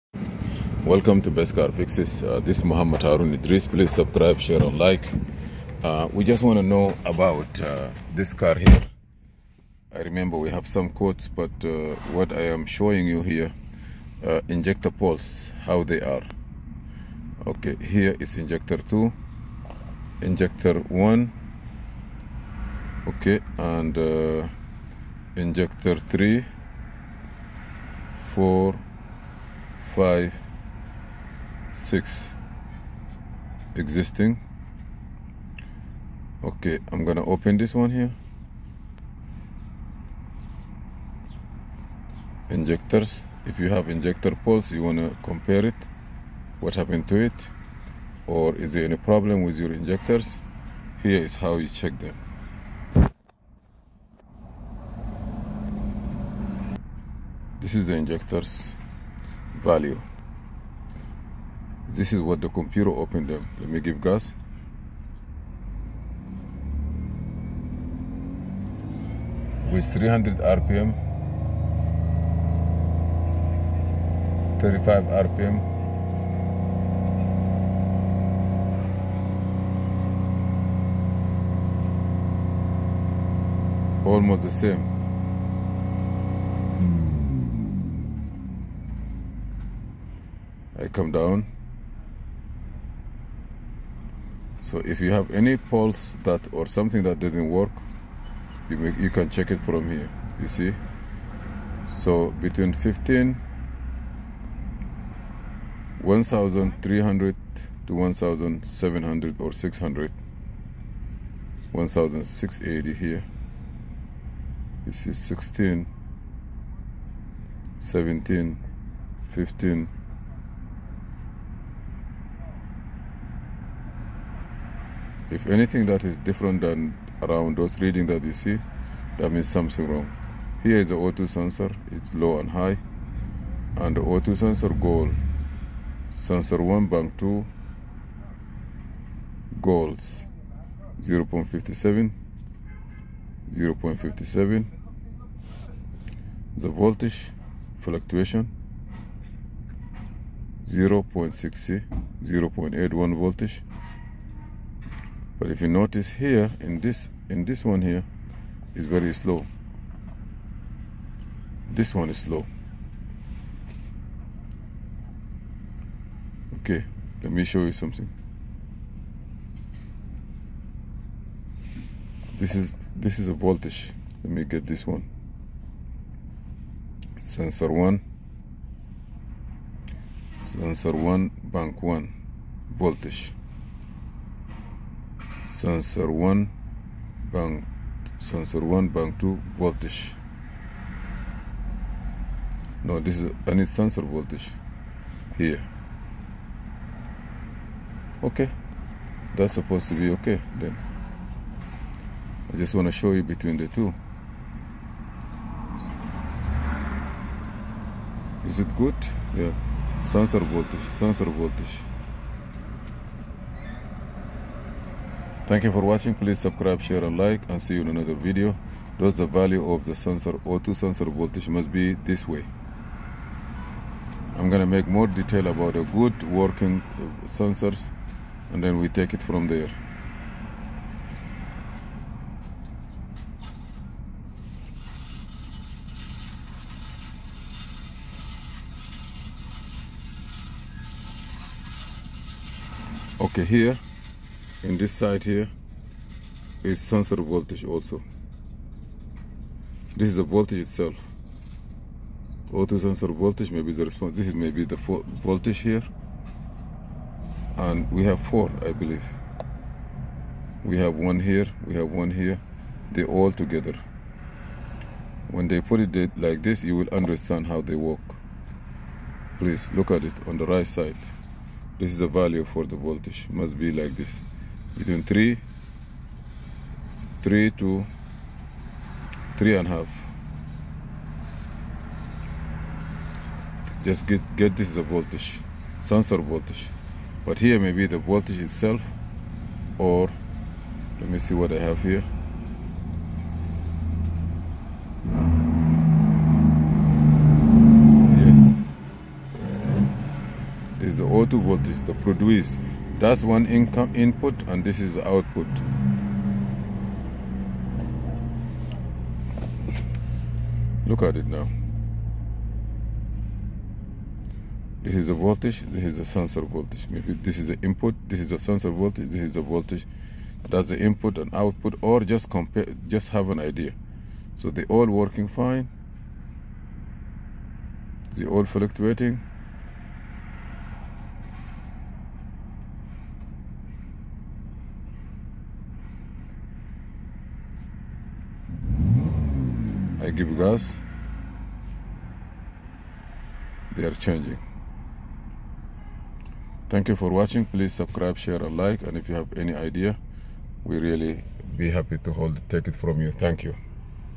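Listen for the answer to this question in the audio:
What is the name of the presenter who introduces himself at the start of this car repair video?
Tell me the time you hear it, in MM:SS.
00:02.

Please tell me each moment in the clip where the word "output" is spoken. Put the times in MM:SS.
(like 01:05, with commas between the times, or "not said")
05:04, 05:21.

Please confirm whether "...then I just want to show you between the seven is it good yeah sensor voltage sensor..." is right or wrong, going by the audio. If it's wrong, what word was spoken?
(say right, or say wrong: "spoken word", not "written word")
wrong: "two", not "seven".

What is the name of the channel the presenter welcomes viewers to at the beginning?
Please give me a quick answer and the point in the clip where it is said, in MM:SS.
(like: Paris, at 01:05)
Best Car Fixes, at 00:01.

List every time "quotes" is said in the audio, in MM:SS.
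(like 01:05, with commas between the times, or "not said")
00:10.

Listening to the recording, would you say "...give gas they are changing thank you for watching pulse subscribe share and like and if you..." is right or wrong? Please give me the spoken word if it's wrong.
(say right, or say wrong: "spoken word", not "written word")
wrong: "please", not "pulse".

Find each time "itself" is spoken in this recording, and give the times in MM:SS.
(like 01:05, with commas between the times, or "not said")
04:10, 04:48.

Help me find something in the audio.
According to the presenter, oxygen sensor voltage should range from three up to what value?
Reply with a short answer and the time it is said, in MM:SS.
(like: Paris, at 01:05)
3.5, at 04:39.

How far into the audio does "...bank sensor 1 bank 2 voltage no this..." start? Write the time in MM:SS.
03:07.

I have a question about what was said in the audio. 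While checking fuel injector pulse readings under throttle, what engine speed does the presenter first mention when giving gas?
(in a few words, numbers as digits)
300 rpm.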